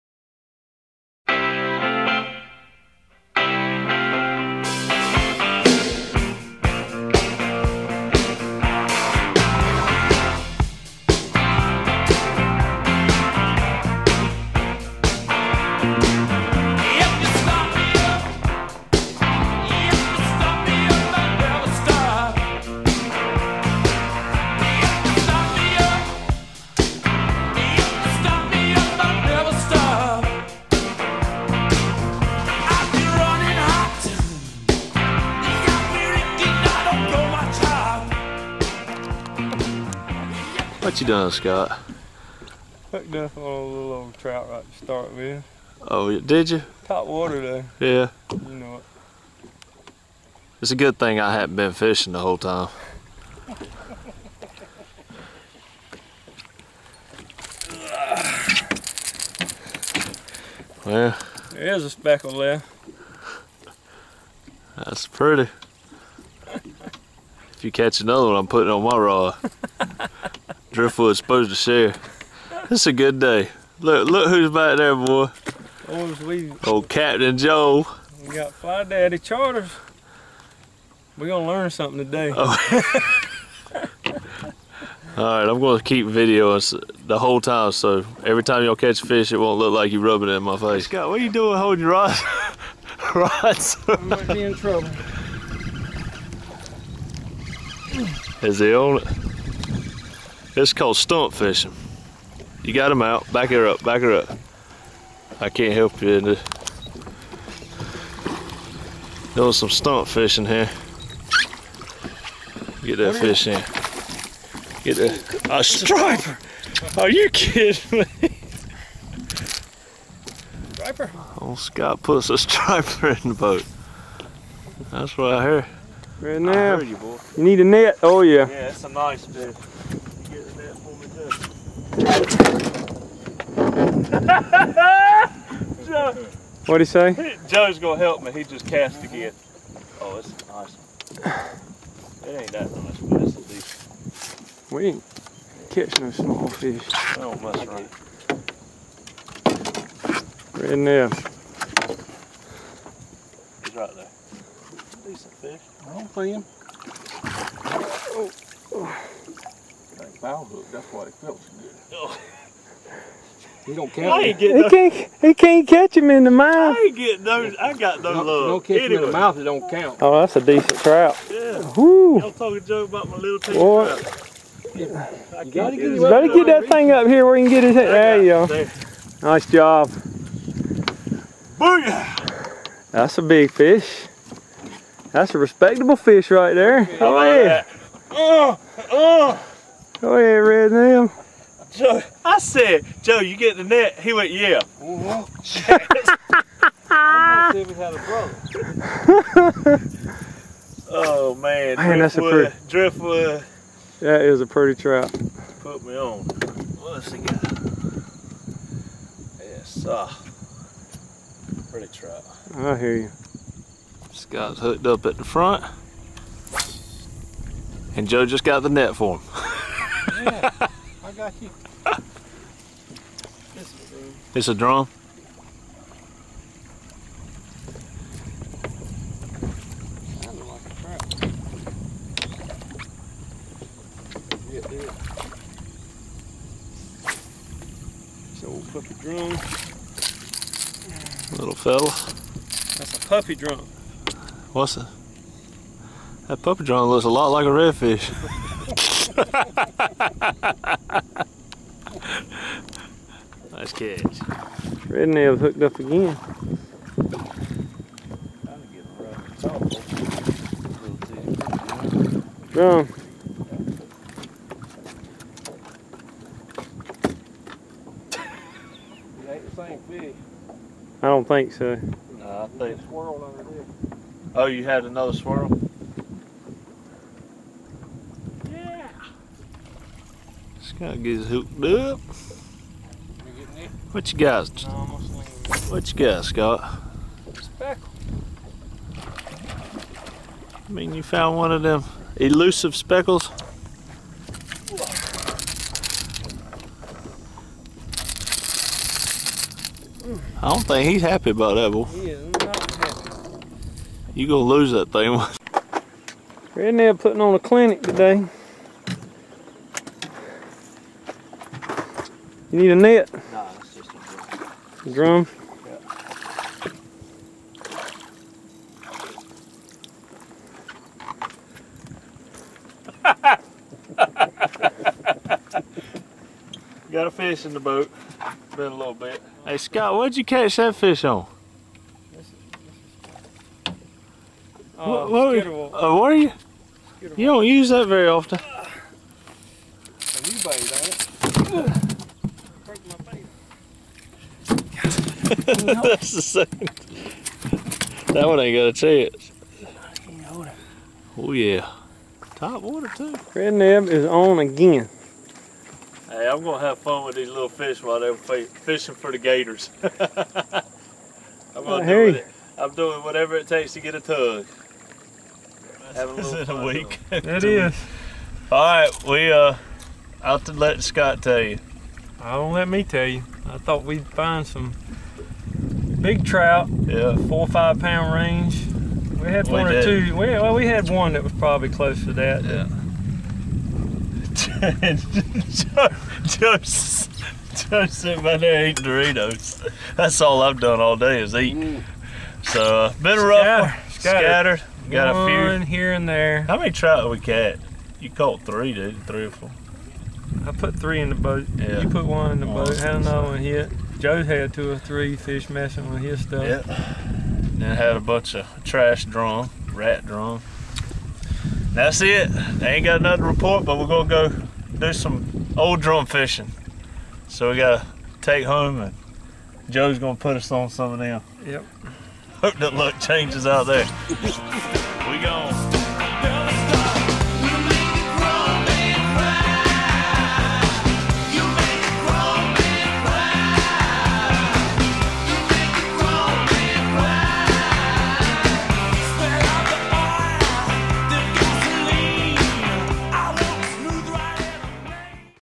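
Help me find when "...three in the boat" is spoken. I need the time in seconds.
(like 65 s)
400 s.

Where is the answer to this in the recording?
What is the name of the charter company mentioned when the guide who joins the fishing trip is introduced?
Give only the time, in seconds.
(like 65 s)
78 s.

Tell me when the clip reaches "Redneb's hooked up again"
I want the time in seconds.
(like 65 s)
254 s.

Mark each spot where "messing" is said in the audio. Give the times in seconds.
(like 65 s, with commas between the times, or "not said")
405 s.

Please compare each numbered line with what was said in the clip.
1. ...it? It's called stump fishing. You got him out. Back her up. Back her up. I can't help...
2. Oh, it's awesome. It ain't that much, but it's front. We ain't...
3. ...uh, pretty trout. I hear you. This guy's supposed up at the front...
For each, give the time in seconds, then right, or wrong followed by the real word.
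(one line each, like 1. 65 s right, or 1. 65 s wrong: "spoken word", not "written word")
1. 99 s right
2. 139 s wrong: "decent", not "front"
3. 210 s wrong: "hooked", not "supposed".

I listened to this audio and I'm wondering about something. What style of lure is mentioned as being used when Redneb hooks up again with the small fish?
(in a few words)
top water.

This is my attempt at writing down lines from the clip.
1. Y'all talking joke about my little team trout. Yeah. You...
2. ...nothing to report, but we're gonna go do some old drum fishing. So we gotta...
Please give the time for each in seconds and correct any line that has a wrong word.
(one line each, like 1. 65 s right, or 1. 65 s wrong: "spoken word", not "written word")
1. 172 s right
2. 413 s right.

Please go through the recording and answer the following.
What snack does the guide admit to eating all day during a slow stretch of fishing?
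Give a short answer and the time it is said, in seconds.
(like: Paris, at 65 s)
Doritos, at 388 s.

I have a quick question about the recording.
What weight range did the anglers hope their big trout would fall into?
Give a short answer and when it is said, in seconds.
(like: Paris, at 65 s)
4 or 5 pounds, at 377 s.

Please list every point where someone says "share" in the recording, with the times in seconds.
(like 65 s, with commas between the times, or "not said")
71 s.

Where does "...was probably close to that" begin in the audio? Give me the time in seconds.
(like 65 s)
381 s.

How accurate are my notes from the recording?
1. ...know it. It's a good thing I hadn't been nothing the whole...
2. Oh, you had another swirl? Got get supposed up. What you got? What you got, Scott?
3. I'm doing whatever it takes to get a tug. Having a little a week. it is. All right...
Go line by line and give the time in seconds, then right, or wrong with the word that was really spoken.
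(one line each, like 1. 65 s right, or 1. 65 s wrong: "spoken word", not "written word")
1. 48 s wrong: "fishing", not "nothing"
2. 274 s wrong: "hooked", not "supposed"
3. 362 s right.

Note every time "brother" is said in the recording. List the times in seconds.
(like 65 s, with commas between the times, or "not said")
199 s.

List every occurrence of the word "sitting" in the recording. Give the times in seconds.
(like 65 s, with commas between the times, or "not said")
387 s.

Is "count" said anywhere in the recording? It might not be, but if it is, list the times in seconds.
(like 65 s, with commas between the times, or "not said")
163 s, 169 s.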